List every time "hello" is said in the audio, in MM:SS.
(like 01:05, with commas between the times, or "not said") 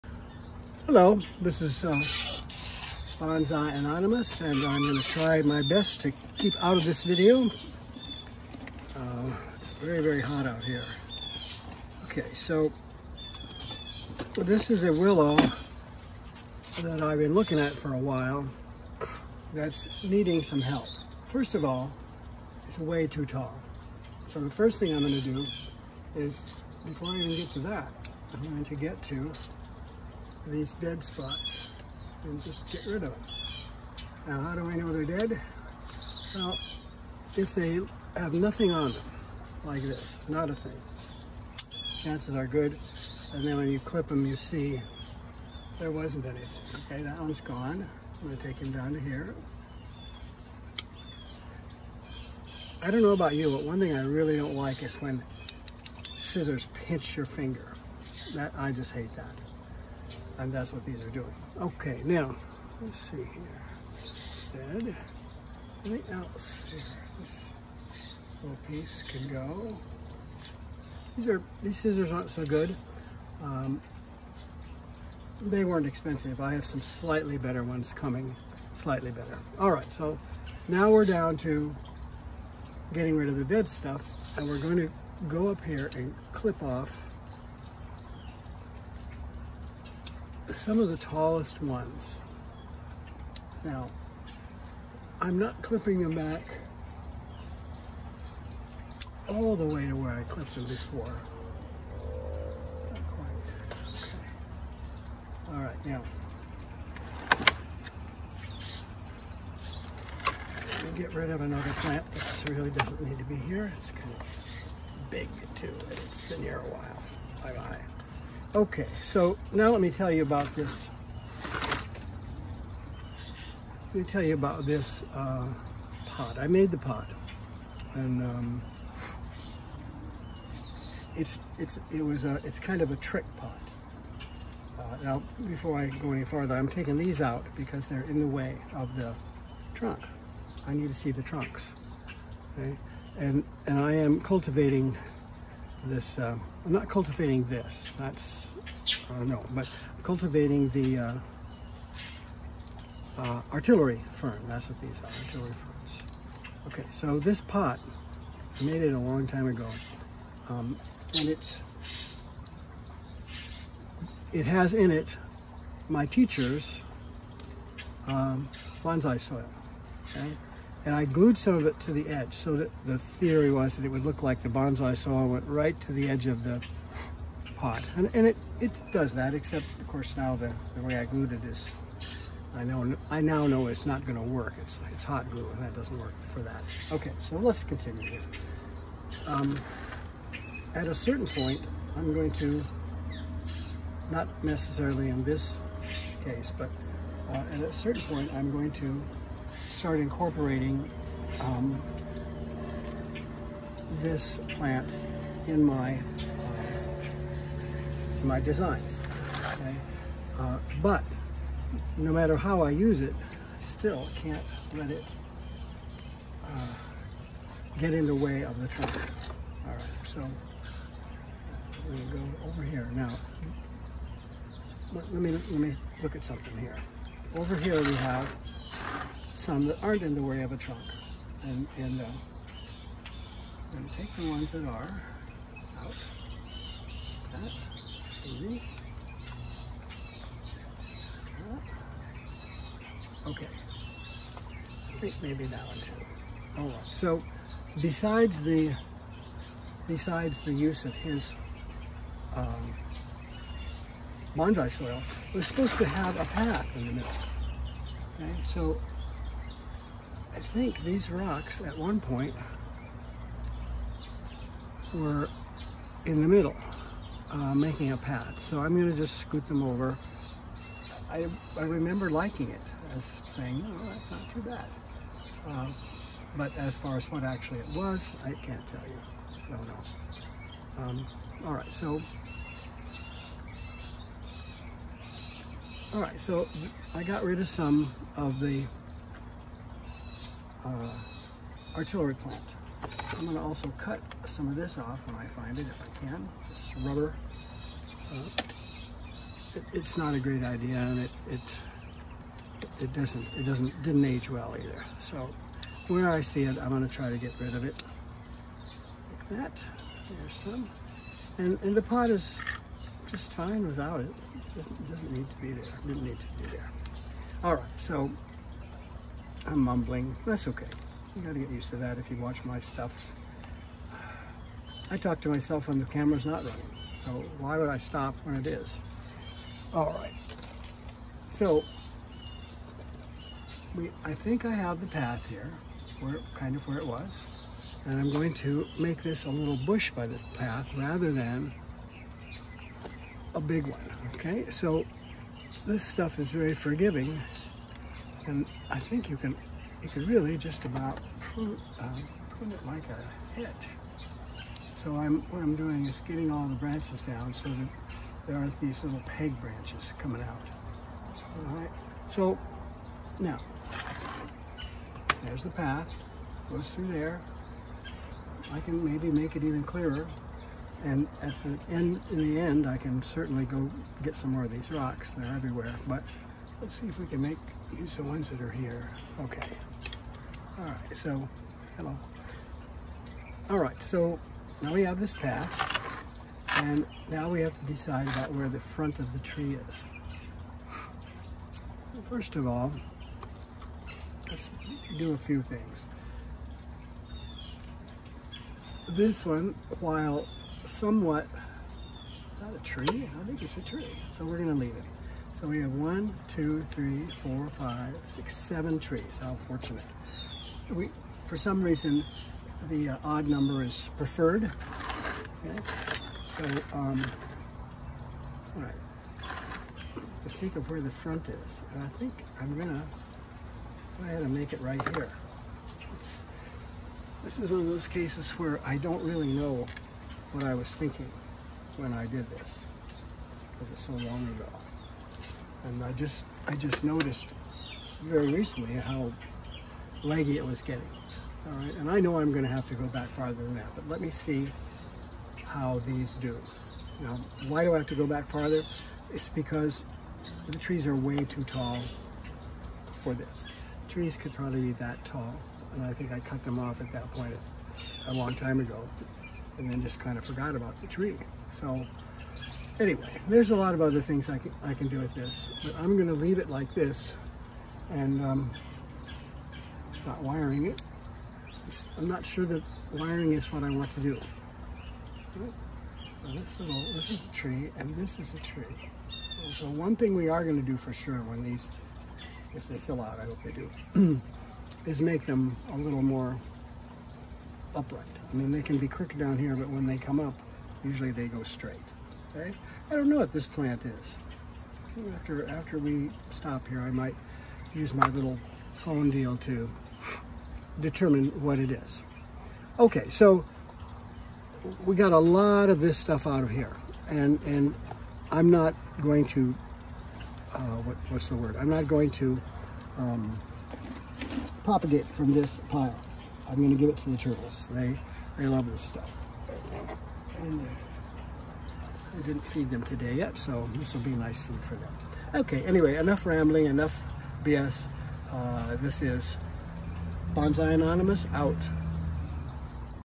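00:00, 06:21.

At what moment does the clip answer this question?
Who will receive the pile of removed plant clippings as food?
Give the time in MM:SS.
08:37.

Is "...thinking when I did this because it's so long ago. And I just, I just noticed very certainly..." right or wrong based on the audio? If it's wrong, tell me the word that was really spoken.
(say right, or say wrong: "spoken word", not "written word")
wrong: "recently", not "certainly".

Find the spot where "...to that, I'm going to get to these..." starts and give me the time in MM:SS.
00:27.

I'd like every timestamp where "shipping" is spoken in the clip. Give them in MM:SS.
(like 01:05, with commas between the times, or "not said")
not said.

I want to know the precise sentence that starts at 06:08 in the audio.
I can maybe make it even clearer.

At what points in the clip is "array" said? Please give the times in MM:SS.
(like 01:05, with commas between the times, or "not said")
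not said.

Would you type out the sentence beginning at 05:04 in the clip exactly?
So where I see it, I'm going to try to get rid of it.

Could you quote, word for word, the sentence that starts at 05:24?
I talk to myself when the camera's not running, so why would I stop when it is?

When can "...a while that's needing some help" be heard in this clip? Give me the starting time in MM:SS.
00:17.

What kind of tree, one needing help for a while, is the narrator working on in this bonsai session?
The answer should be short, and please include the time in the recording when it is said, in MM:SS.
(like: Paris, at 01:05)
Willow, at 00:14.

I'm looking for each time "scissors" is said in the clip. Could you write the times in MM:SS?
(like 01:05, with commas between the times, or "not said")
00:56, 01:11.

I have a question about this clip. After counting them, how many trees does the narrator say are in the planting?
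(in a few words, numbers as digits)
7.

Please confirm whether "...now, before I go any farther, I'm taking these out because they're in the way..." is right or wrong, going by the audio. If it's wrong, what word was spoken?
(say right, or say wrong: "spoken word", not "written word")
right.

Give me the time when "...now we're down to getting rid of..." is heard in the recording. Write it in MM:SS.
01:20.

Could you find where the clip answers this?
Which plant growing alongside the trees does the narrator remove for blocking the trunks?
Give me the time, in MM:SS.
02:33.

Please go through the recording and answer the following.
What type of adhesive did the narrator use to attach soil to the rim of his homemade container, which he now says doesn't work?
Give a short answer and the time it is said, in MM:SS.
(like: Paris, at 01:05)
Hot glue, at 03:05.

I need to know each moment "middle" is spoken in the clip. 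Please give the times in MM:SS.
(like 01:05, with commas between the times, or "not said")
04:16, 04:26.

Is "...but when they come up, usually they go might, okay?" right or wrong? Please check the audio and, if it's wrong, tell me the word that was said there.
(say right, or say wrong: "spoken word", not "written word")
wrong: "straight", not "might".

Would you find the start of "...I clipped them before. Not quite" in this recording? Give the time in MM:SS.
01:40.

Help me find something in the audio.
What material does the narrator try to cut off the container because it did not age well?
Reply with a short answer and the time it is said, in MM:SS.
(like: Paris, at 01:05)
Rubber, at 04:56.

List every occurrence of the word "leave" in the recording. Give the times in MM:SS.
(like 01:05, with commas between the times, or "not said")
06:44, 07:46.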